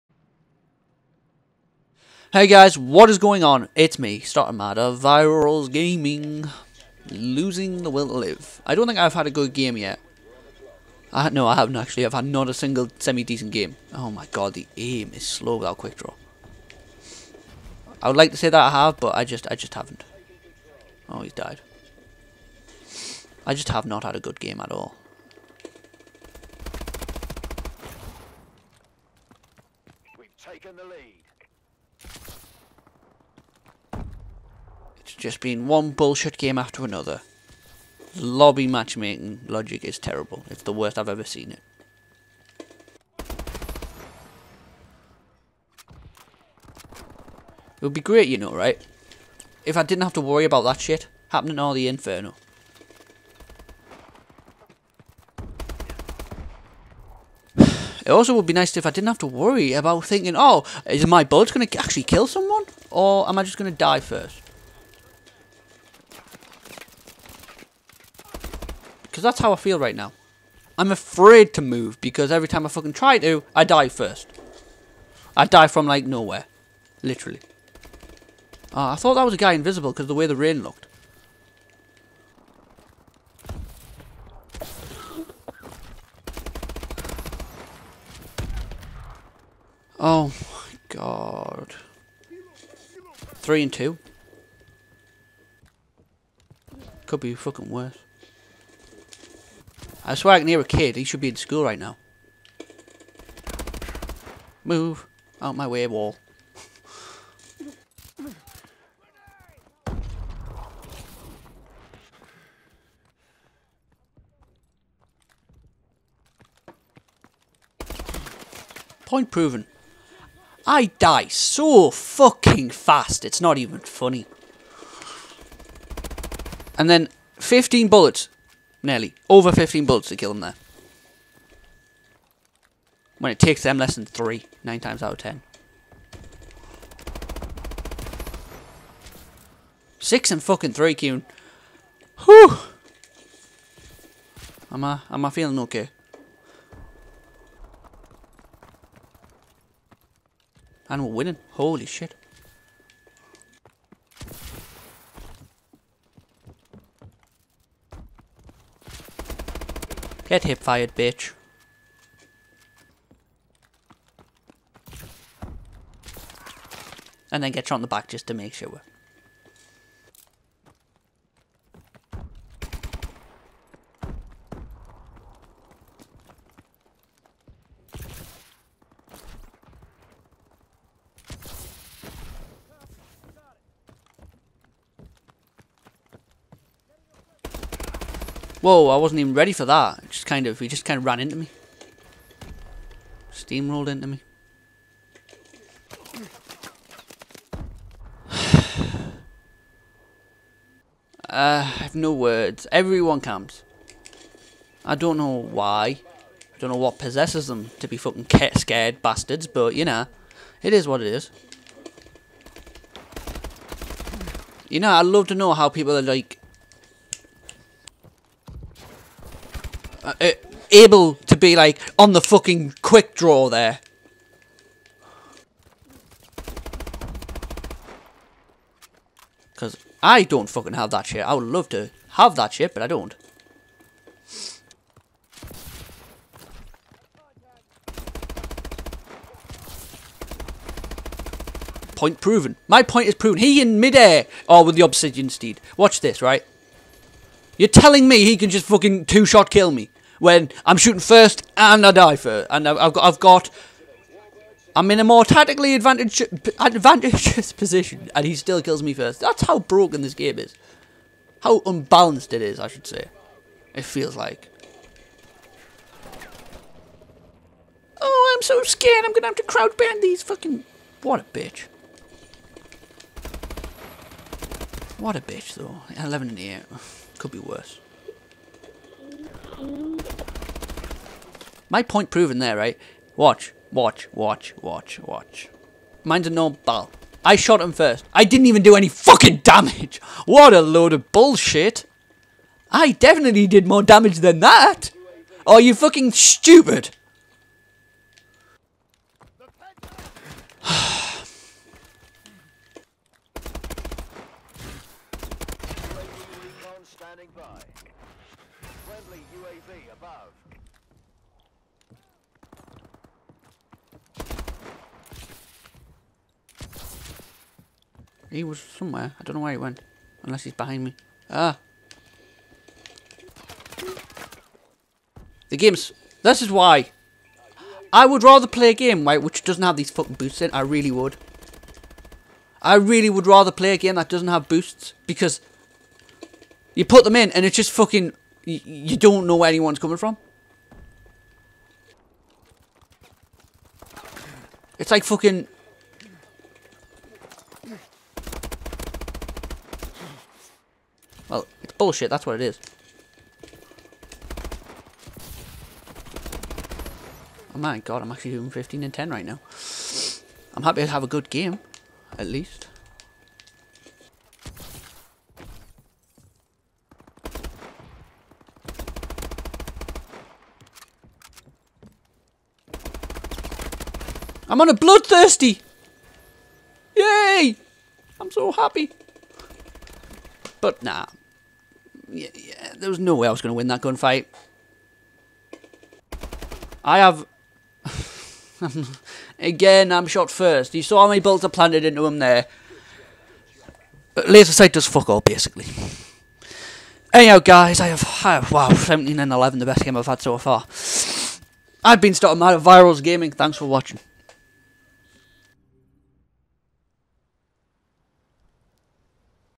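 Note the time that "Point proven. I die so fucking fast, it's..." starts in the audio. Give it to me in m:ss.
1:59.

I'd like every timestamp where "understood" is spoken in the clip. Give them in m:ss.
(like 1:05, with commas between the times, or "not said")
not said.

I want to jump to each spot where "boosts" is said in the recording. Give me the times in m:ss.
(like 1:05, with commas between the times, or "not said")
5:30, 5:34.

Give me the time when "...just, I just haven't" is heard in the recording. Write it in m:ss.
0:19.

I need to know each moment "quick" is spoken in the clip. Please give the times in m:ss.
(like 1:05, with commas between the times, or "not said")
0:15, 3:42.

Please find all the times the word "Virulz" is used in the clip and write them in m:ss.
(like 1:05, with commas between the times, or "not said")
0:04, 6:42.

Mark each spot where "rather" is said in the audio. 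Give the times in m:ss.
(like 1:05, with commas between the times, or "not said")
5:28, 5:33.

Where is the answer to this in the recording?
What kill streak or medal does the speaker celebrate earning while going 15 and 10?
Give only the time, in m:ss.
6:14.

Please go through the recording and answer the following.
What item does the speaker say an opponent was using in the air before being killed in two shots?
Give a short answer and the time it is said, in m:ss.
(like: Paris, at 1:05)
obsidian steed, at 4:04.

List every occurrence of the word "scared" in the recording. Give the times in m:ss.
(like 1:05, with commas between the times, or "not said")
3:28, 4:28.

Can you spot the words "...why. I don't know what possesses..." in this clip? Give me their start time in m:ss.
3:25.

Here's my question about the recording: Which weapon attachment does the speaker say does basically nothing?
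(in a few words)
laser sight.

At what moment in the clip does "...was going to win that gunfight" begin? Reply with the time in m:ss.
6:23.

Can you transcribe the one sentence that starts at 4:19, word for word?
That's how broken this game is.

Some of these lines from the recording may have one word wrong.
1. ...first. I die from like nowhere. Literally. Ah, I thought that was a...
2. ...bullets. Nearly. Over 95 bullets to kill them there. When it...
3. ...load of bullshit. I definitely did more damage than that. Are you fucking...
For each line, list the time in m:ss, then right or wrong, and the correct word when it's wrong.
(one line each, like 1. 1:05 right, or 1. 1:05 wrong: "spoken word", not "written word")
1. 1:13 right
2. 2:07 wrong: "15", not "95"
3. 4:50 right.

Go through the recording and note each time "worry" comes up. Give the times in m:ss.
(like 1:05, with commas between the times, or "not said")
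0:50, 0:59.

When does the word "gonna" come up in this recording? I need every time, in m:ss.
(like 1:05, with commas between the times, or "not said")
4:29.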